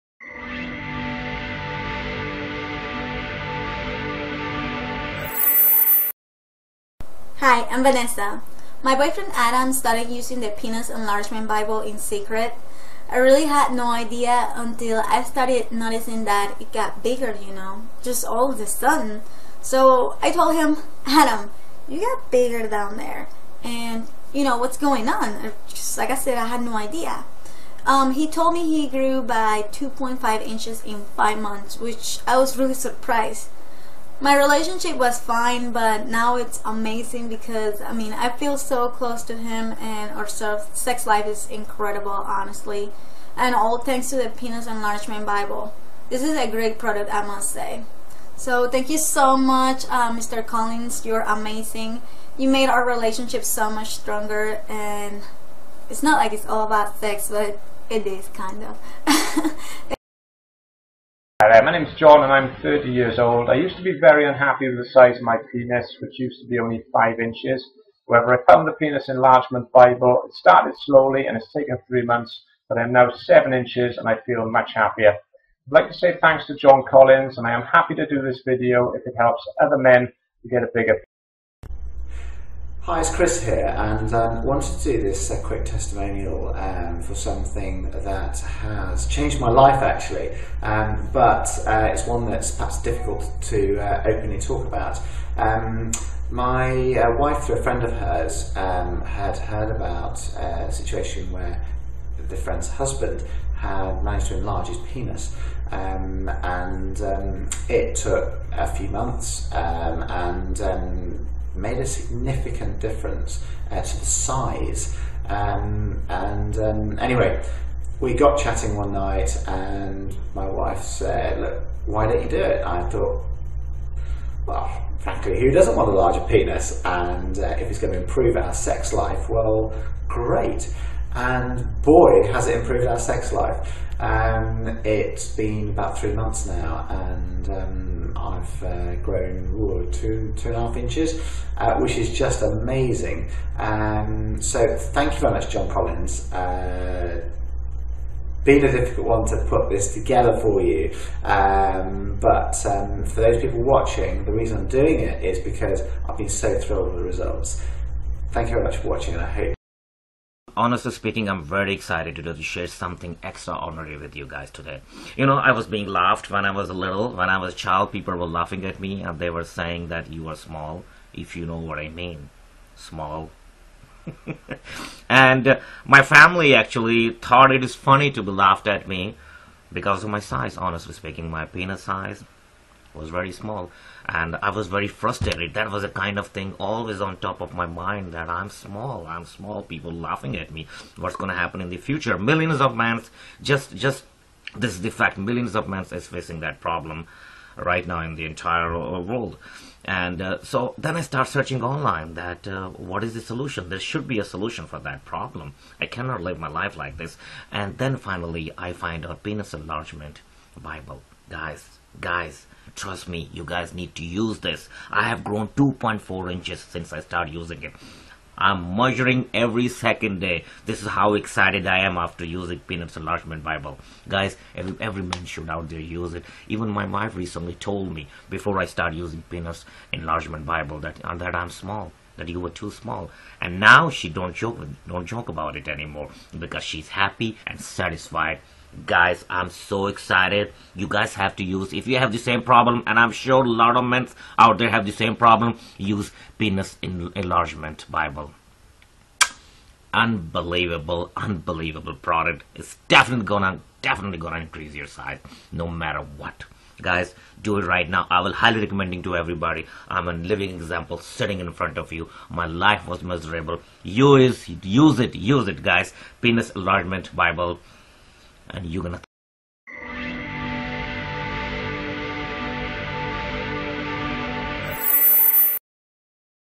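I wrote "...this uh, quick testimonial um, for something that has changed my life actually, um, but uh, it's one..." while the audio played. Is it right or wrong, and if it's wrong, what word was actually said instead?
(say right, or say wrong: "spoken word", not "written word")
right.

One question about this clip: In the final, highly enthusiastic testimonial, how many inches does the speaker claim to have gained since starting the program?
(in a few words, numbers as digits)
2.4 inches.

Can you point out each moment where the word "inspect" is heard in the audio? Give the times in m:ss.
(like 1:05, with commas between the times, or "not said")
not said.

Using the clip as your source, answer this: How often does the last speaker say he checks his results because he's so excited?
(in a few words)
Every second day.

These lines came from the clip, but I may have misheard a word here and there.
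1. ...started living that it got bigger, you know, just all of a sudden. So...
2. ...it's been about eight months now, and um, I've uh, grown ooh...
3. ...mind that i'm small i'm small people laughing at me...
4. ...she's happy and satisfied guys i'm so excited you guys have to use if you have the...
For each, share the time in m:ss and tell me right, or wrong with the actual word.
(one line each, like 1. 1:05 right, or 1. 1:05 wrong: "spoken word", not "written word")
1. 0:15 wrong: "noticing", not "living"
2. 2:14 wrong: "three", not "eight"
3. 3:07 right
4. 3:56 right.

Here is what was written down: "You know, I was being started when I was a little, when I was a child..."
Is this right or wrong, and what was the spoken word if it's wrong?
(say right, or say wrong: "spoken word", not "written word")
wrong: "laughed", not "started".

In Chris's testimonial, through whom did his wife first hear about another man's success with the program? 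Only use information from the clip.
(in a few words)
A friend of hers.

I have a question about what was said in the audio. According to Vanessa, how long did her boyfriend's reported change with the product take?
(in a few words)
5 months.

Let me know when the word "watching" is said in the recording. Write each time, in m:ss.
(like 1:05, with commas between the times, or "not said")
2:33, 2:38.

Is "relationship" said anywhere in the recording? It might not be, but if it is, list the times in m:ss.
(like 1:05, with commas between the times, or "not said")
0:34, 0:52.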